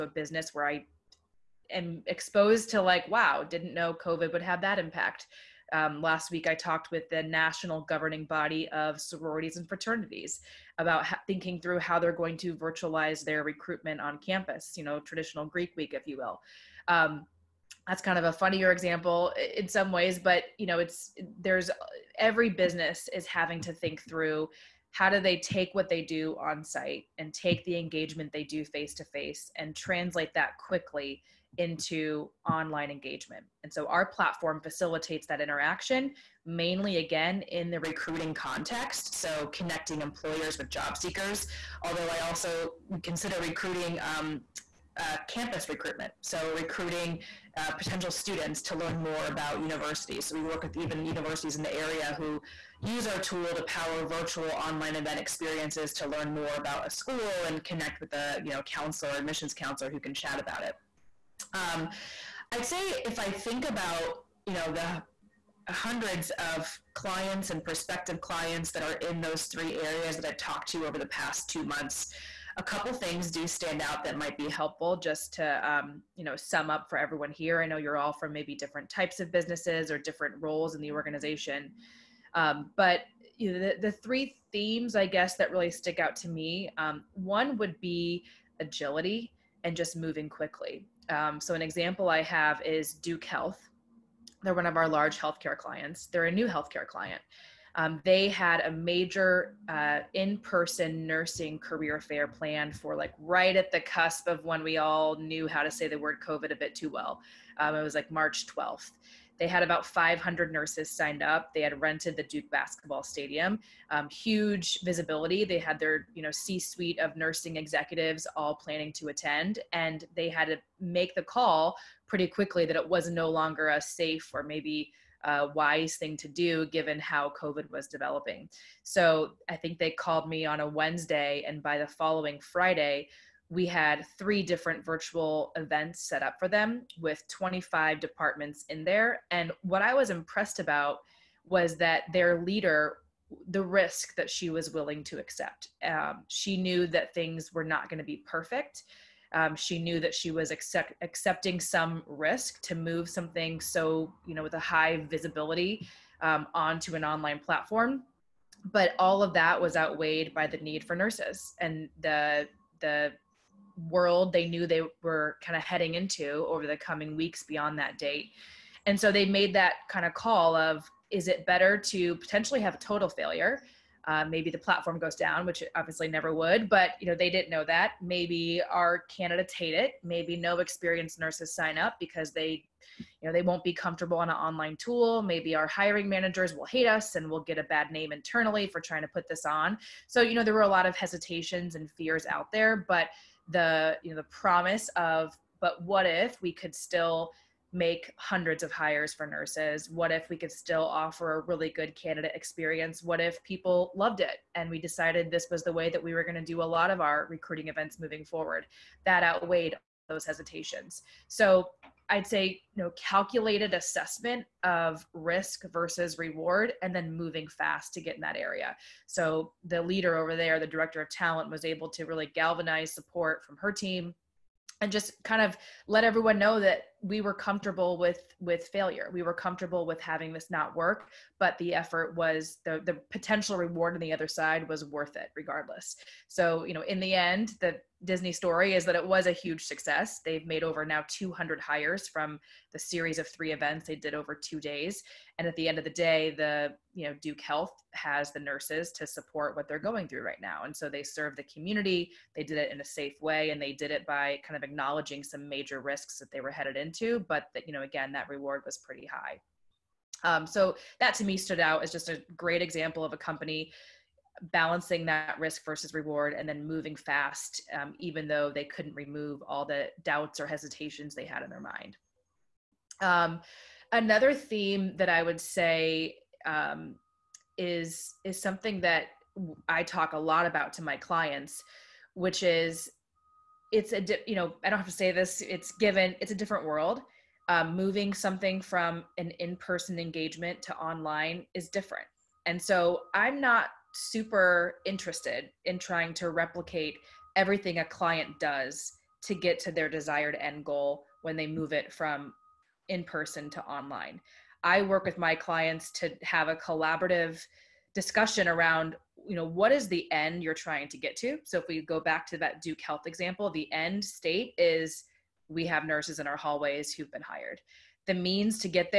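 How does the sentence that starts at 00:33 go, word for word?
And so our platform facilitates that interaction mainly again in the recruiting context.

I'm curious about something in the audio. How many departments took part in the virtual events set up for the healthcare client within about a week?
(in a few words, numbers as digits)
25.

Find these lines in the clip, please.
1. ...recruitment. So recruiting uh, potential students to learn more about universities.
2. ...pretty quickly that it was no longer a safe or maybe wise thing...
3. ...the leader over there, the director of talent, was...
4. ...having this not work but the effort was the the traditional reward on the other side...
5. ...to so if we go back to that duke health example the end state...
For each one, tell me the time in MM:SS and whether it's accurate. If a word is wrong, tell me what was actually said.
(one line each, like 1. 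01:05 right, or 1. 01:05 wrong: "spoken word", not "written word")
1. 00:45 right
2. 02:02 right
3. 03:39 right
4. 03:50 wrong: "potential", not "traditional"
5. 05:11 right.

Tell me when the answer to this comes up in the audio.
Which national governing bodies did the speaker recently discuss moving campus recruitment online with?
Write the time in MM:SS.
00:09.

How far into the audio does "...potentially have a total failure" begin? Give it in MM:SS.
02:52.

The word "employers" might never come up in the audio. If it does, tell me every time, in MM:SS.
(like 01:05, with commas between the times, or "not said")
00:39.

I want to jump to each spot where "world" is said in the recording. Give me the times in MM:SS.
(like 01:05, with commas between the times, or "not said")
02:43, 04:46.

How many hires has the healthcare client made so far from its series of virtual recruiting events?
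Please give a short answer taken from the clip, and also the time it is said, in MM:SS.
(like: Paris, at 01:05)
200, at 04:01.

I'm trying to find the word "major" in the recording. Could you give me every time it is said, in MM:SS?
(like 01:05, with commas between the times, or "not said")
01:38, 04:15.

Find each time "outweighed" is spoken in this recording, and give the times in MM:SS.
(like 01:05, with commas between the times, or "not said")
02:39, 03:29.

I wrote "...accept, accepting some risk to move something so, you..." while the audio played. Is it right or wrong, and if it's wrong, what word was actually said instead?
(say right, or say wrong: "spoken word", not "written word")
right.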